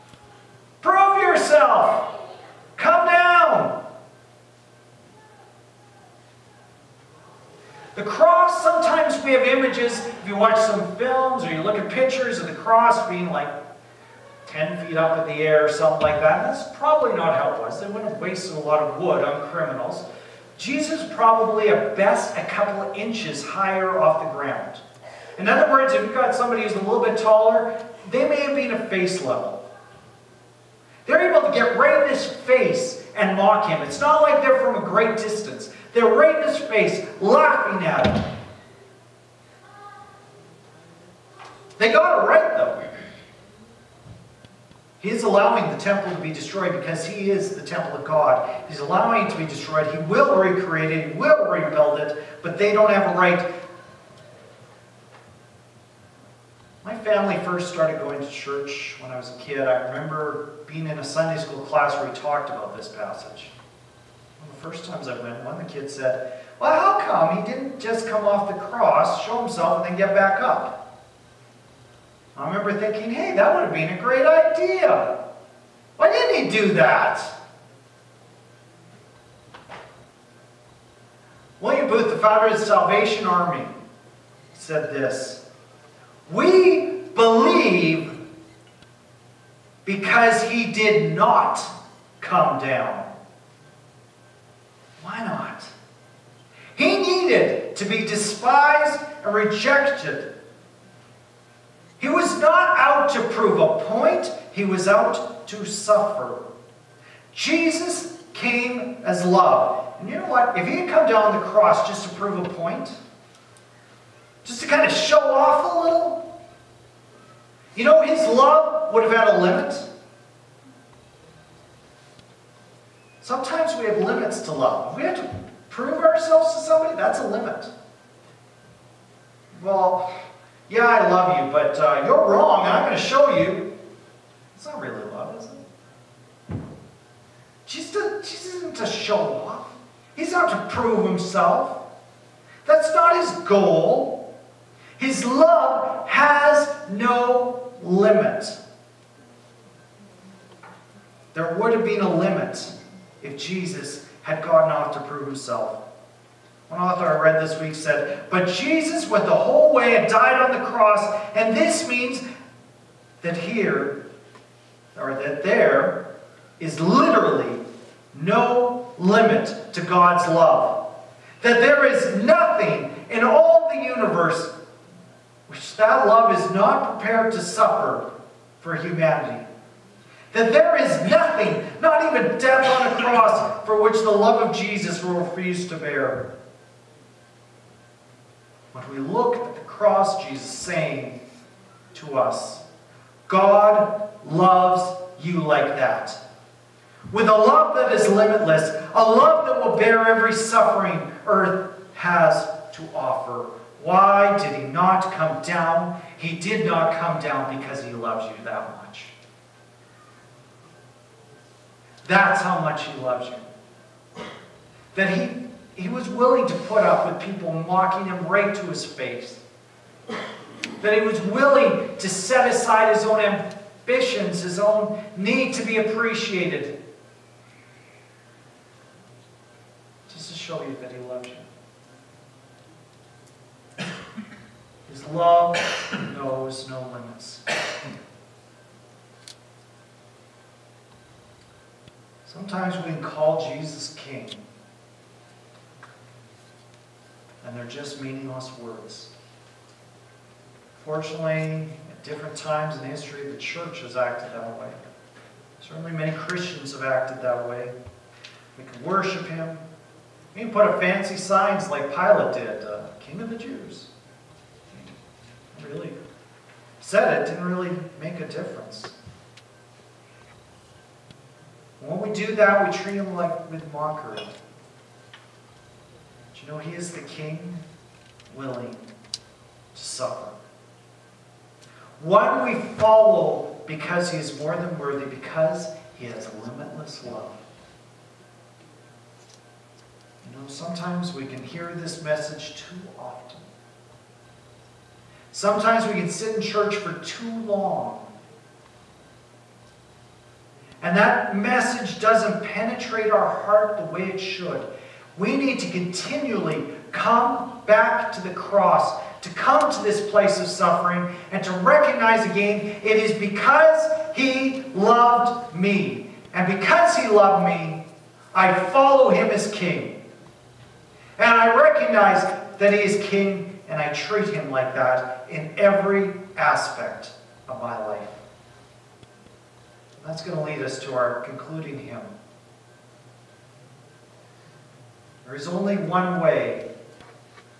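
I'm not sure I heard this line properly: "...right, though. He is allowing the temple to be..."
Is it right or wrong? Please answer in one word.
right.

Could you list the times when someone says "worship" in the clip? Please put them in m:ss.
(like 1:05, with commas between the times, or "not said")
4:18.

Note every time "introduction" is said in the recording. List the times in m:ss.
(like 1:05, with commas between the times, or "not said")
not said.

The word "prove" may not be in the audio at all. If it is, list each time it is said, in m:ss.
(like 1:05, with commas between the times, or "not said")
1:43, 1:52, 2:05, 2:20, 2:35.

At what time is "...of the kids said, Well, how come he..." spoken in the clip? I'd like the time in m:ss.
1:05.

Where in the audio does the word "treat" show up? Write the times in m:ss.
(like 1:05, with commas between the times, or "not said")
4:32, 5:23.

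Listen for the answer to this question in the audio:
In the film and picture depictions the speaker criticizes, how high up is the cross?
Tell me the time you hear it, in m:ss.
0:14.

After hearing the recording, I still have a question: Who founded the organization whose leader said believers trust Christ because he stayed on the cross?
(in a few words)
William Booth.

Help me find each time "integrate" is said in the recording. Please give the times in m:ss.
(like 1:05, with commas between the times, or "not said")
not said.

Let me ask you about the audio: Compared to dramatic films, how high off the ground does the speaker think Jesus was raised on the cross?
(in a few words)
a couple of inches.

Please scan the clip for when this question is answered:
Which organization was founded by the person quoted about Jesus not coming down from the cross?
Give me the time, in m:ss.
1:22.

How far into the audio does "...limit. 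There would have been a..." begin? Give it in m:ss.
2:27.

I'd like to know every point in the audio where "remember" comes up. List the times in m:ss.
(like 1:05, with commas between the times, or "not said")
0:59, 1:12.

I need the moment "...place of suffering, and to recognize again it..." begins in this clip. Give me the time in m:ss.
5:10.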